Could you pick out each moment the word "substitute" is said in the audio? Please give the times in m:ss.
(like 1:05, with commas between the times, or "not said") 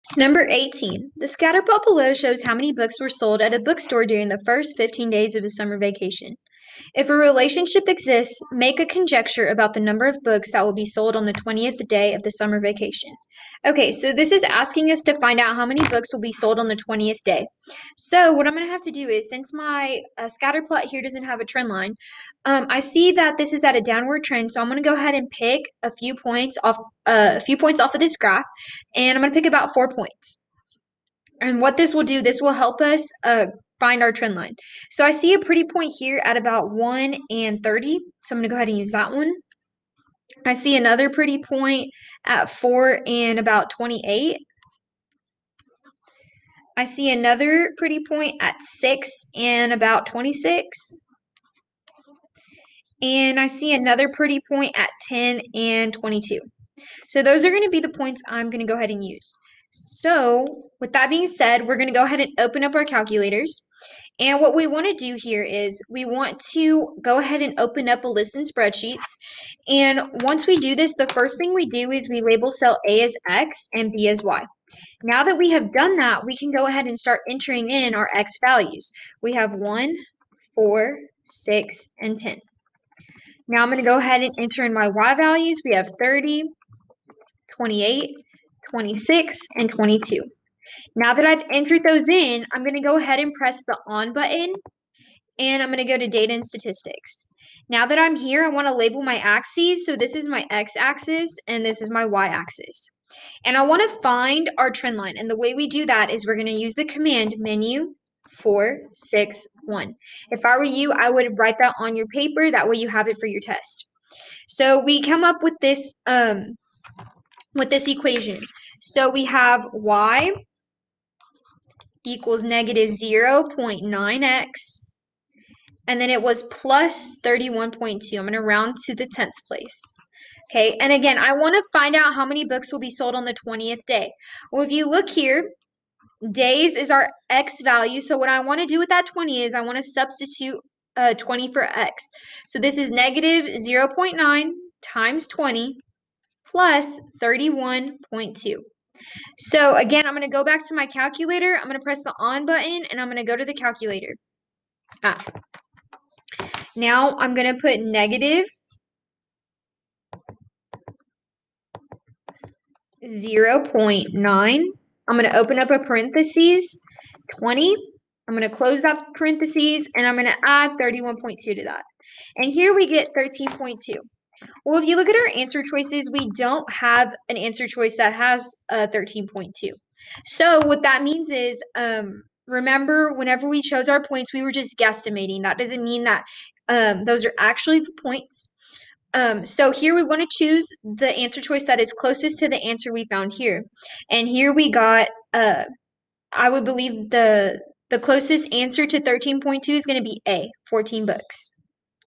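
2:19.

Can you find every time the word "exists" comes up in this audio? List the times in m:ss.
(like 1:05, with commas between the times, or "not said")
0:07.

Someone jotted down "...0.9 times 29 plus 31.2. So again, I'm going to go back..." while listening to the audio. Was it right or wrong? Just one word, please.
wrong.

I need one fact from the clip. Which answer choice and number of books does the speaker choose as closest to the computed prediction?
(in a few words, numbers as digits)
A, 14 books.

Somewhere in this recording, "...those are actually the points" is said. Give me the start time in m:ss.
3:07.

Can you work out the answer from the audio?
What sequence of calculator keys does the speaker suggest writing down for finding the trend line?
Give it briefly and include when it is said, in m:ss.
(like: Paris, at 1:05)
4, 6, 1, at 1:48.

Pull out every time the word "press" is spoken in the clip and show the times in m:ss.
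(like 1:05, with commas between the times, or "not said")
1:33, 2:31.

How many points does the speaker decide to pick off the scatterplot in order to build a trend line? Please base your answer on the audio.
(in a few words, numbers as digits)
4.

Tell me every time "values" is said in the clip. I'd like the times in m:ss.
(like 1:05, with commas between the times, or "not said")
1:18, 1:25, 2:17.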